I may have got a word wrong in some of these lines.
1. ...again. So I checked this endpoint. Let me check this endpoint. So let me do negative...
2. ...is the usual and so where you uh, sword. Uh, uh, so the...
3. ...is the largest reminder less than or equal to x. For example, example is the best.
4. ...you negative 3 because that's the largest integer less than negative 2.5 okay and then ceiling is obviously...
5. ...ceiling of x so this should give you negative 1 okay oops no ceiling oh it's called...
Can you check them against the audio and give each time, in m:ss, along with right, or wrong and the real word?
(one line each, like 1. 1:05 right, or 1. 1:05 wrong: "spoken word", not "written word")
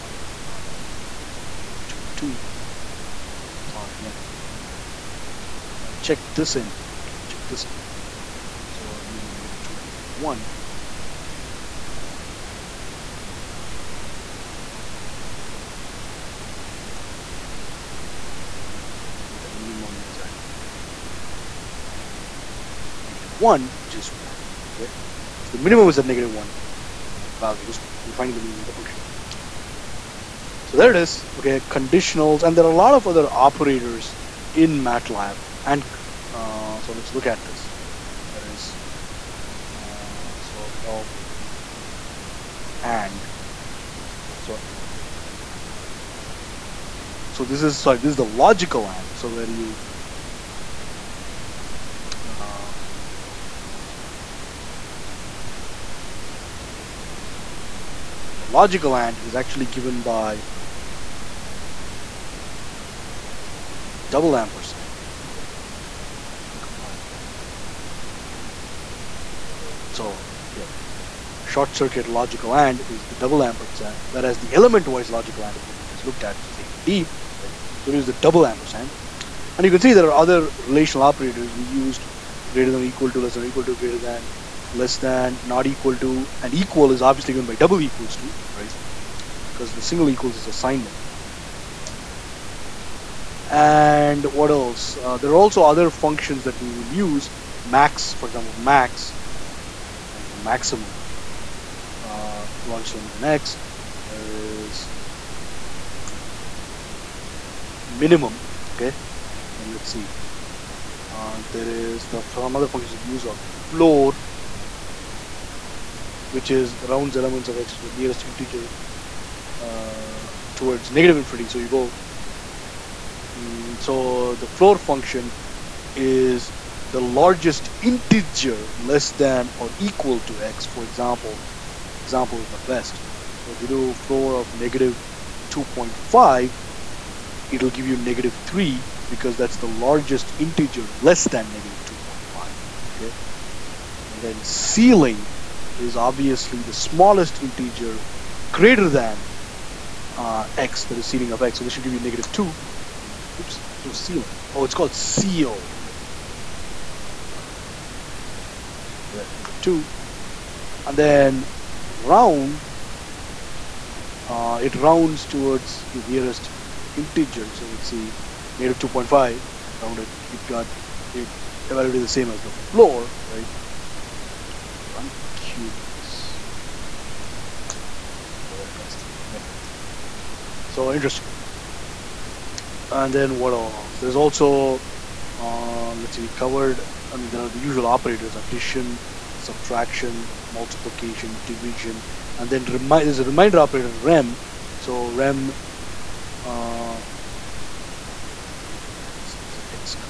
1. 0:03 right
2. 0:48 wrong: "logical", not "usual"
3. 2:05 wrong: "integer", not "reminder"
4. 2:17 right
5. 2:31 wrong: "2", not "1".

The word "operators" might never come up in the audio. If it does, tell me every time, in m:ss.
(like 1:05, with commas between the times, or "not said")
0:33, 1:21, 3:07, 3:13.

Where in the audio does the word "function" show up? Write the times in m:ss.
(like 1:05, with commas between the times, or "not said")
0:28, 1:35, 1:52, 2:04.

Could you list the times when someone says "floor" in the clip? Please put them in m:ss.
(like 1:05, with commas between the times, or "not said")
1:53, 2:04, 2:13, 2:52.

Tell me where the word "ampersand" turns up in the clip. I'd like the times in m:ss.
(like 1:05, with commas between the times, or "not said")
1:04, 1:13, 1:18.